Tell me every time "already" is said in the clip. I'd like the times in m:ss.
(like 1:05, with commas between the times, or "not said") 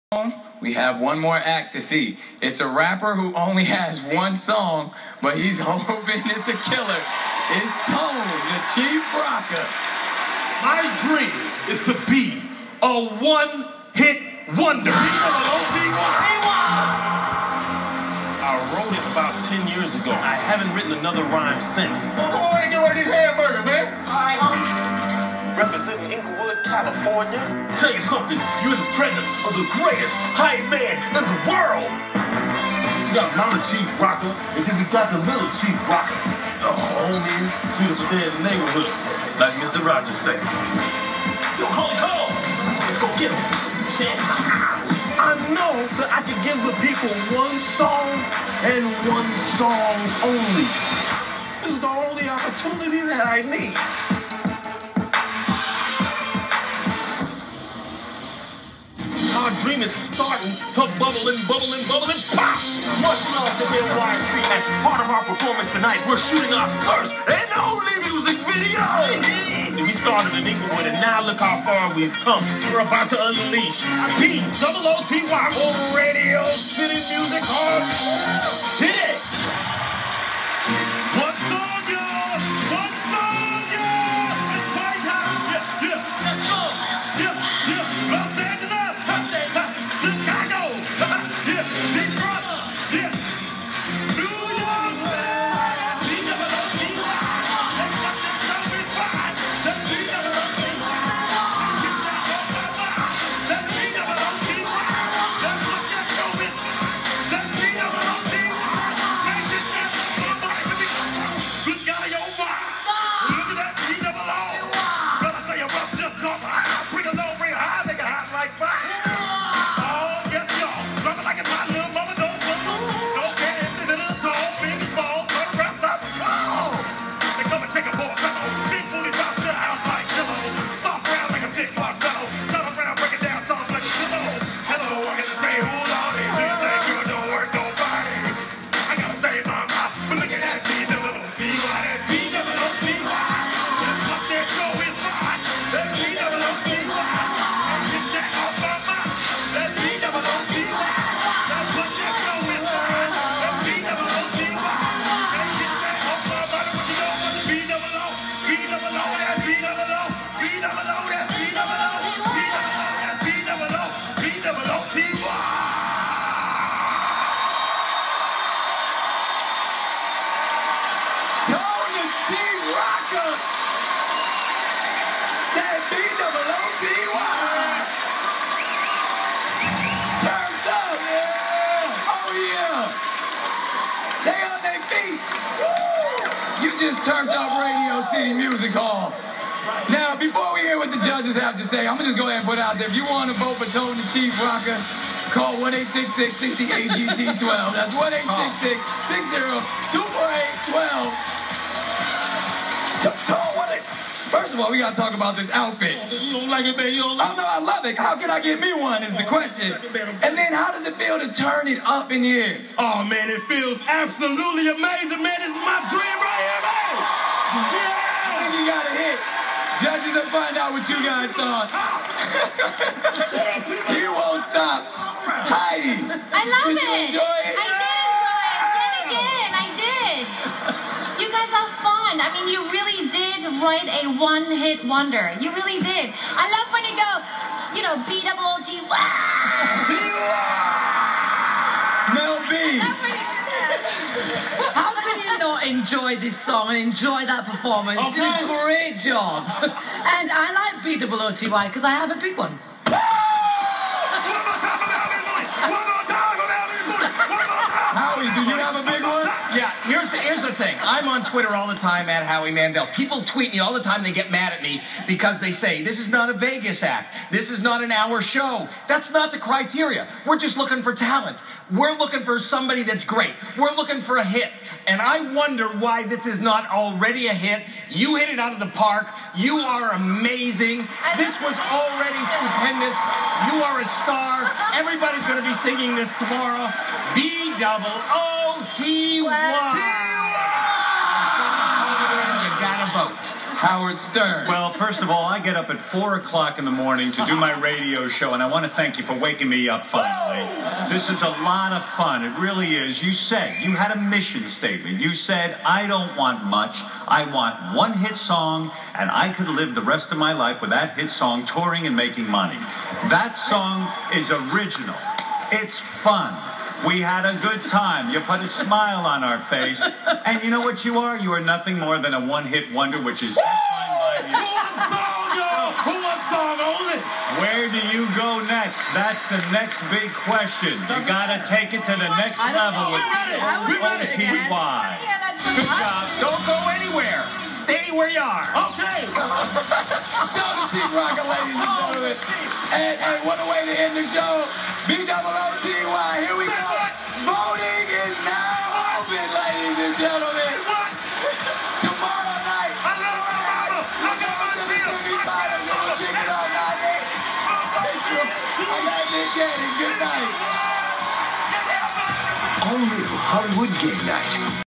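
4:36, 4:41.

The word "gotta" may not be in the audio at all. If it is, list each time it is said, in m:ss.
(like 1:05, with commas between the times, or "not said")
3:24, 5:31.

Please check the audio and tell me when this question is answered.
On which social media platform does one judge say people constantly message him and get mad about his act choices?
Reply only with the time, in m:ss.
4:21.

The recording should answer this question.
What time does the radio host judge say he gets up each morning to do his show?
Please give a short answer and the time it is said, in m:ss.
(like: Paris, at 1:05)
4 o'clock, at 4:55.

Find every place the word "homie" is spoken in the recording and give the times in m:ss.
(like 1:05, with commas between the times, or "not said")
0:36.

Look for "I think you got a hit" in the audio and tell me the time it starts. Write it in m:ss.
3:38.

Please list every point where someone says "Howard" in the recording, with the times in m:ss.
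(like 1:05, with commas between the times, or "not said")
4:53.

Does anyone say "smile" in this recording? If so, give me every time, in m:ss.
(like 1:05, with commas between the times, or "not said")
5:18.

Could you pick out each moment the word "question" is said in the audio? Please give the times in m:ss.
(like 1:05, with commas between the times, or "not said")
3:29, 5:30.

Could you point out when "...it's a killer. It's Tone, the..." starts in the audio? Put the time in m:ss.
0:06.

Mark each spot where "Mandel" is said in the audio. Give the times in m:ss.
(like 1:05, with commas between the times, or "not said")
4:22.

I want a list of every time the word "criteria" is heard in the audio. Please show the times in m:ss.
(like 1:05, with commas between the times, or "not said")
4:29.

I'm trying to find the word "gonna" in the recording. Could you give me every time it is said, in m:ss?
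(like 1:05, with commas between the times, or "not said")
3:11.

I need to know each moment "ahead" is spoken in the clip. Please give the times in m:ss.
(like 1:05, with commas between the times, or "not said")
3:12.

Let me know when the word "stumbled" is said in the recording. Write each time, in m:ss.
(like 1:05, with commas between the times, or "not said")
not said.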